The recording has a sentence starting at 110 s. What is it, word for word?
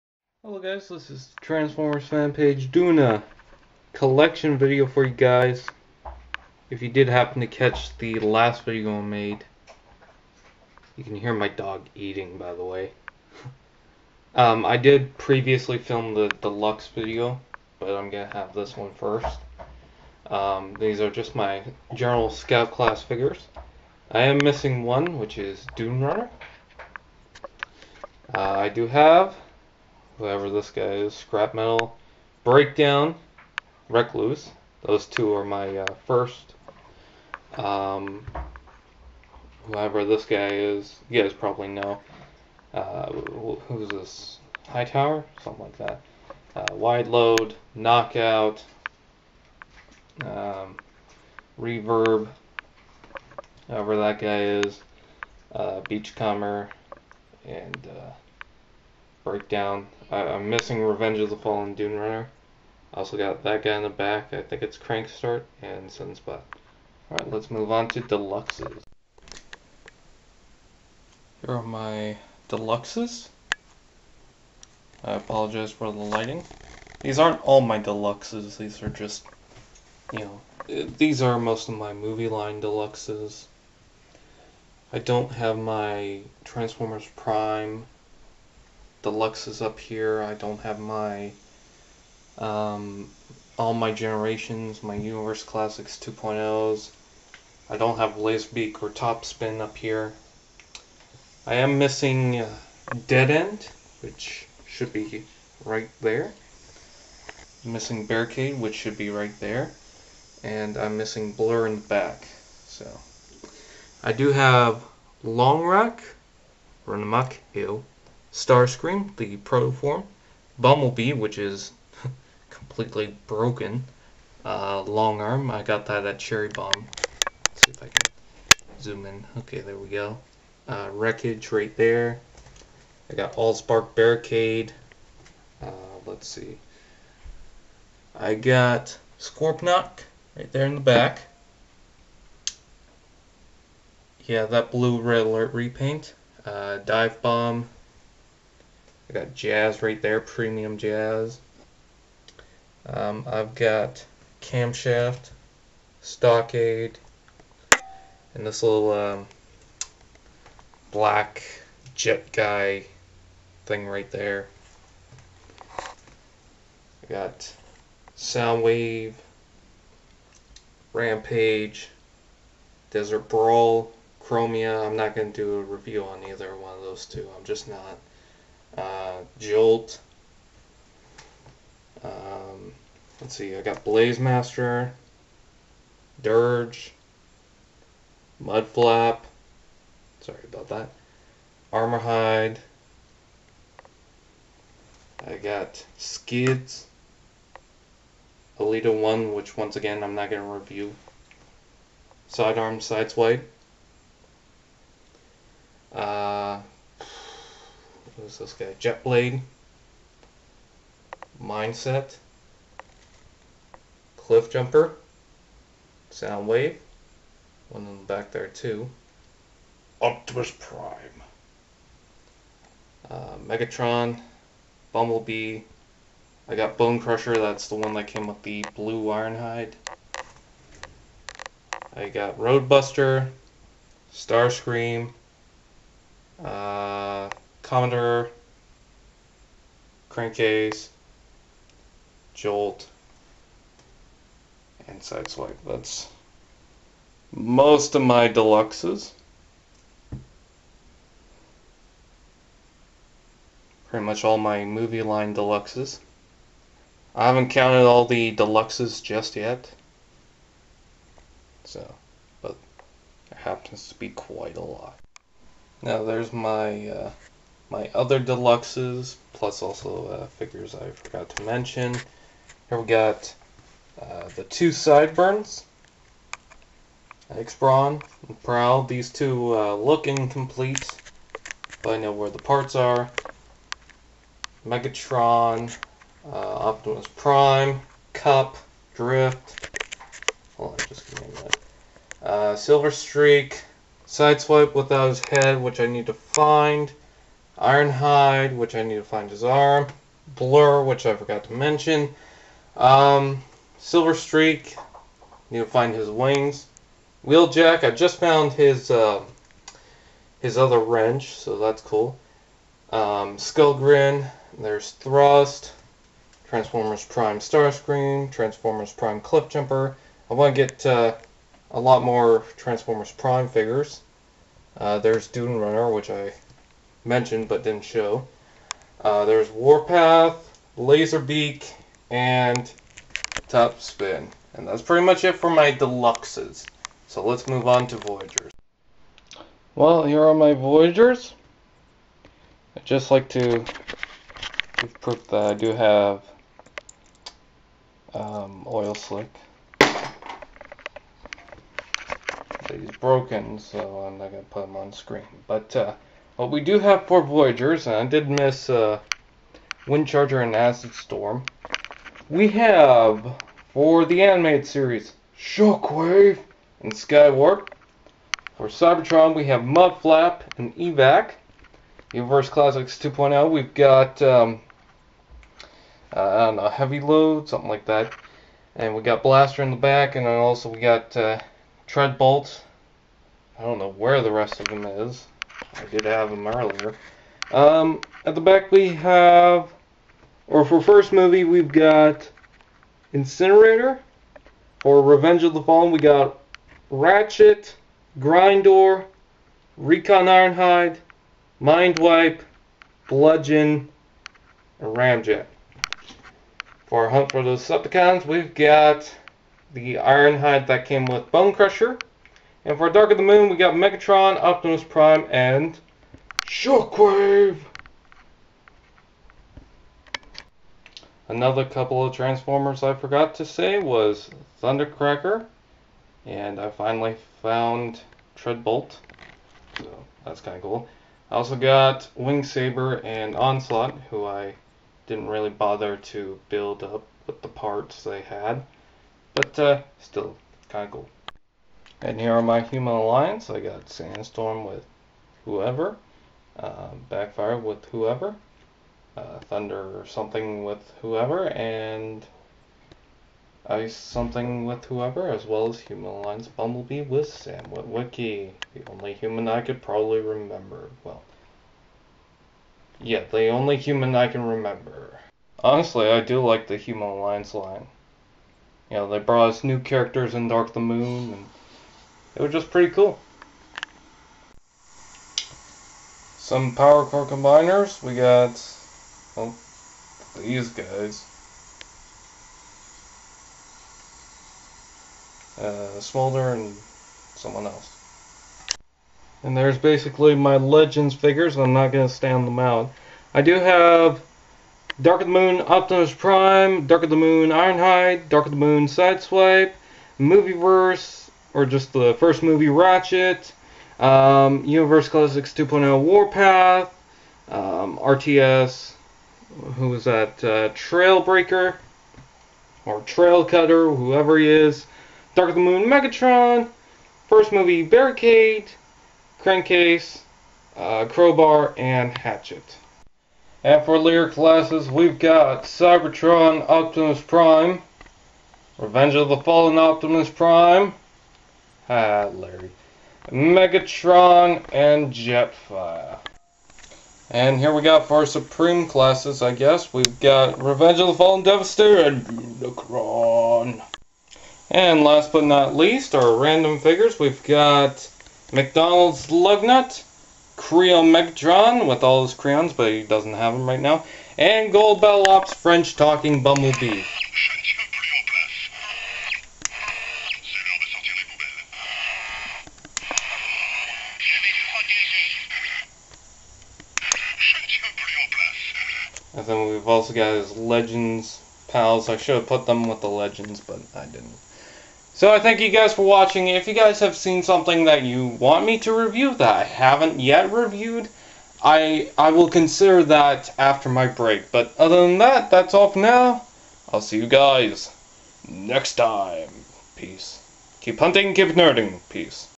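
And I'm missing Blur in the back.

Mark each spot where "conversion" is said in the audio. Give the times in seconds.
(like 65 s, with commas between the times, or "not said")
not said.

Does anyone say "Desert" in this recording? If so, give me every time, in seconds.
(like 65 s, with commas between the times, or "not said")
172 s.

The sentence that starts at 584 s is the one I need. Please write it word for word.
But other than that, that's all for now.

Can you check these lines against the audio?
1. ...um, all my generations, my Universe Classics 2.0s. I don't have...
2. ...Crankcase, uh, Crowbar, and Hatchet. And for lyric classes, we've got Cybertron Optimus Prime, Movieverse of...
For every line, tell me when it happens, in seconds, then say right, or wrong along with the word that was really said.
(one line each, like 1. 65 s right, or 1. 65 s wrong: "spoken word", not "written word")
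1. 92 s right
2. 519 s wrong: "Revenge", not "Movieverse".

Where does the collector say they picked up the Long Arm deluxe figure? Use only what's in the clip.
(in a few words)
Cherry Bomb.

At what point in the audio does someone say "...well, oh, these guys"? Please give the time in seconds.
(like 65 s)
479 s.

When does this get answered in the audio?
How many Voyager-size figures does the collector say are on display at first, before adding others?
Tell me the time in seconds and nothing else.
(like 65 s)
357 s.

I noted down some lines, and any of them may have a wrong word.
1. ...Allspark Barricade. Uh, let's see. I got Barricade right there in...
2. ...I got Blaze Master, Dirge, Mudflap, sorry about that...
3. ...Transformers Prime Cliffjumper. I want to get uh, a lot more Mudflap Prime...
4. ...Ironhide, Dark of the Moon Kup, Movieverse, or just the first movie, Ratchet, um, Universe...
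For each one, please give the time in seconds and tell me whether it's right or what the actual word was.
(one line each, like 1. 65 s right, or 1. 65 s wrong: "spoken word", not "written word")
1. 133 s wrong: "Scorponok", not "Barricade"
2. 183 s right
3. 318 s wrong: "Transformers", not "Mudflap"
4. 497 s wrong: "Sideswipe", not "Kup".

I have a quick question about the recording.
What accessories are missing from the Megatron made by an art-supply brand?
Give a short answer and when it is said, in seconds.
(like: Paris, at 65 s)
crayons, at 552 s.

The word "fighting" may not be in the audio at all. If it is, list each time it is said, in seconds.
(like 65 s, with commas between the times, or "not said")
not said.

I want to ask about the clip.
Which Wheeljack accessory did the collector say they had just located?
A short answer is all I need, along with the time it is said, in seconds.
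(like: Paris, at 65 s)
his other wrench, at 310 s.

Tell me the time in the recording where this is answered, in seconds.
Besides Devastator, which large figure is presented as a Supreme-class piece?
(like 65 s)
542 s.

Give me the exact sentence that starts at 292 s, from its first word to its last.
Uh, Silver Streak, Sideswipe without his head, which I need to find.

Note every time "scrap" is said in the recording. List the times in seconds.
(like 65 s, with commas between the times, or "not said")
31 s.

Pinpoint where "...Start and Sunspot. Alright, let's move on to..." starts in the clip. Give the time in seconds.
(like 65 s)
65 s.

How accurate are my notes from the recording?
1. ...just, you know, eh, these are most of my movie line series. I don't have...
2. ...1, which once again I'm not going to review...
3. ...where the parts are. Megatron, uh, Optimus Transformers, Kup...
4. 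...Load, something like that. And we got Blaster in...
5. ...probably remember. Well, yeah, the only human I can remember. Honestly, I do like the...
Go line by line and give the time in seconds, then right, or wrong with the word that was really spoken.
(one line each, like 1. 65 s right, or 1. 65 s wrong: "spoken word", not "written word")
1. 78 s wrong: "deluxes", not "series"
2. 198 s right
3. 282 s wrong: "Prime", not "Transformers"
4. 377 s right
5. 459 s right.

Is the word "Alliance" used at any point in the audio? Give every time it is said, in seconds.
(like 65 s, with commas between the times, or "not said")
442 s, 456 s, 467 s.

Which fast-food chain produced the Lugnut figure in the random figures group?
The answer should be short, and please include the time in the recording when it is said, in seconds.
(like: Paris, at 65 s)
McDonald's, at 548 s.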